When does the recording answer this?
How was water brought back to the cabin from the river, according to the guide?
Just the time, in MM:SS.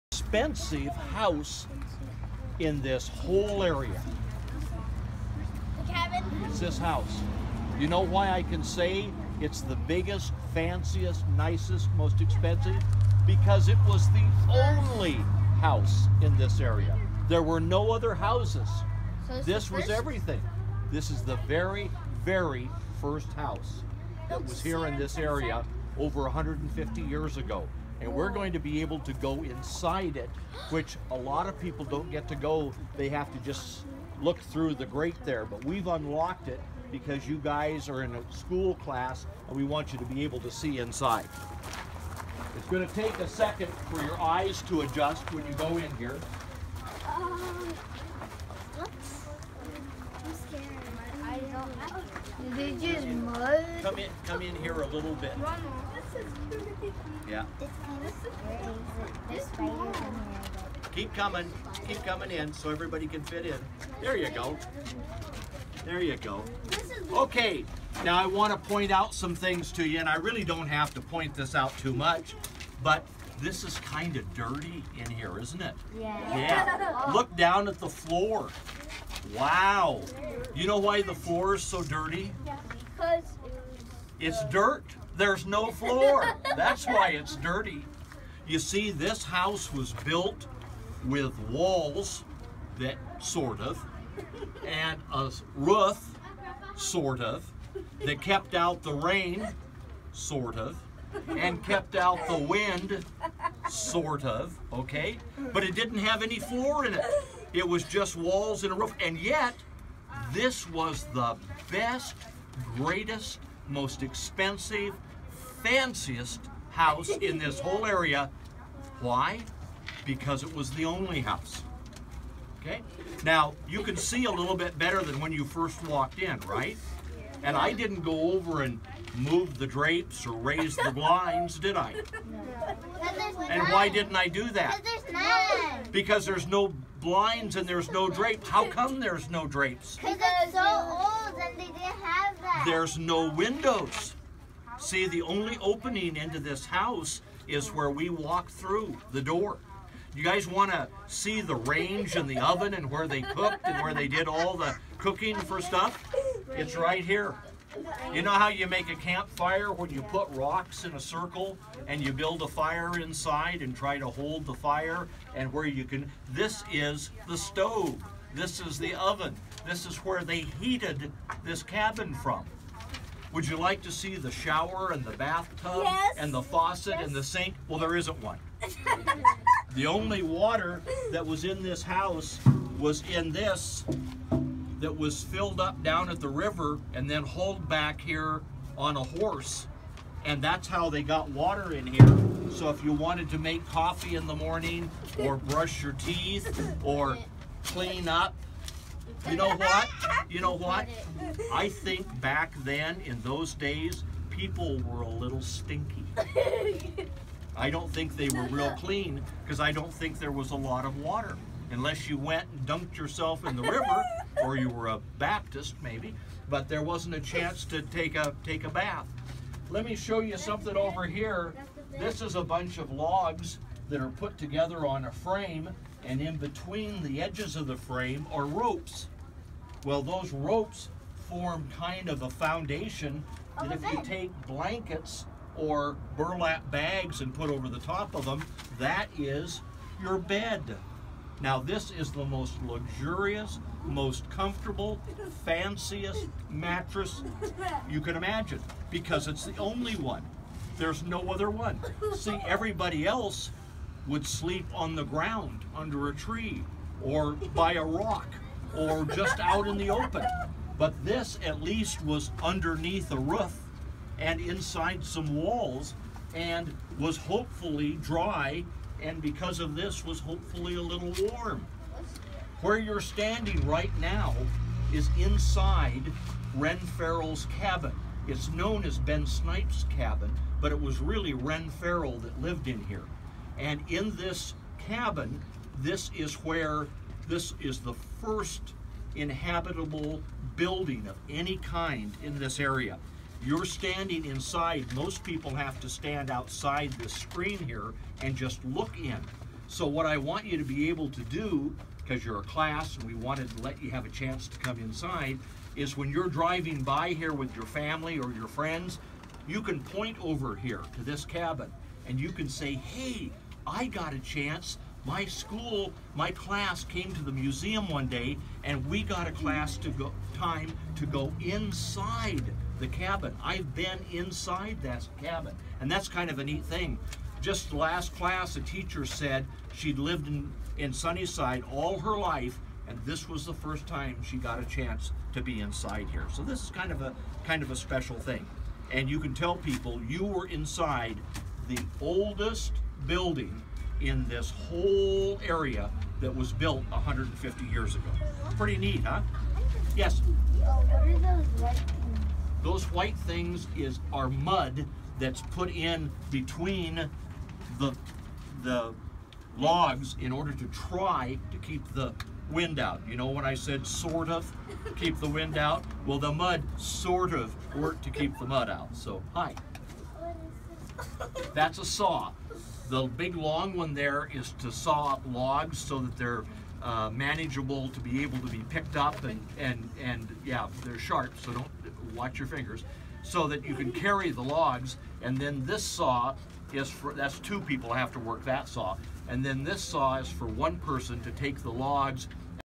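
03:08.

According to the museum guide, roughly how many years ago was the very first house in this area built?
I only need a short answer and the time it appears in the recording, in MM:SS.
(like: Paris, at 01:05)
150 years, at 00:25.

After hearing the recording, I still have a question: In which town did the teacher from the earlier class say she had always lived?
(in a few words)
Sunnyside.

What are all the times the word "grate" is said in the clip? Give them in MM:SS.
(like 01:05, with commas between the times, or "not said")
00:34.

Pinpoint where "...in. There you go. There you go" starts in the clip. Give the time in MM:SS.
01:03.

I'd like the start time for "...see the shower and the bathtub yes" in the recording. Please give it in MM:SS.
02:53.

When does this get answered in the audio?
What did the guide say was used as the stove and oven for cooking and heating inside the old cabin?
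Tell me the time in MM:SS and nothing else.
02:40.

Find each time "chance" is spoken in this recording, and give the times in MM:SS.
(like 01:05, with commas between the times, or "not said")
03:37, 05:04, 05:14, 05:34.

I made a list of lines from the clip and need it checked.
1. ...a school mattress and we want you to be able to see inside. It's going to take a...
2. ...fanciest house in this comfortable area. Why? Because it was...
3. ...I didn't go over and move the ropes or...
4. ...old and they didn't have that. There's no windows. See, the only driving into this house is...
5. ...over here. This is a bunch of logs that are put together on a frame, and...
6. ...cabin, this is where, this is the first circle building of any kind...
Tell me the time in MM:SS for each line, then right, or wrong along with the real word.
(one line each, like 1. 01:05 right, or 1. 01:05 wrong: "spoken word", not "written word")
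1. 00:38 wrong: "class", not "mattress"
2. 01:55 wrong: "whole", not "comfortable"
3. 02:07 wrong: "drapes", not "ropes"
4. 02:20 wrong: "opening", not "driving"
5. 03:40 right
6. 04:44 wrong: "inhabitable", not "circle".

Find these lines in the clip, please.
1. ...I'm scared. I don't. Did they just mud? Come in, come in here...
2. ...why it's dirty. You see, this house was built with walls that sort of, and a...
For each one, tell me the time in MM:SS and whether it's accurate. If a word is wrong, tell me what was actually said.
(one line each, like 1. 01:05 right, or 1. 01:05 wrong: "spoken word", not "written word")
1. 00:48 right
2. 01:26 right.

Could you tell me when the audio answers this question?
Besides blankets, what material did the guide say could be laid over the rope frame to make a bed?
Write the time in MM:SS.
03:56.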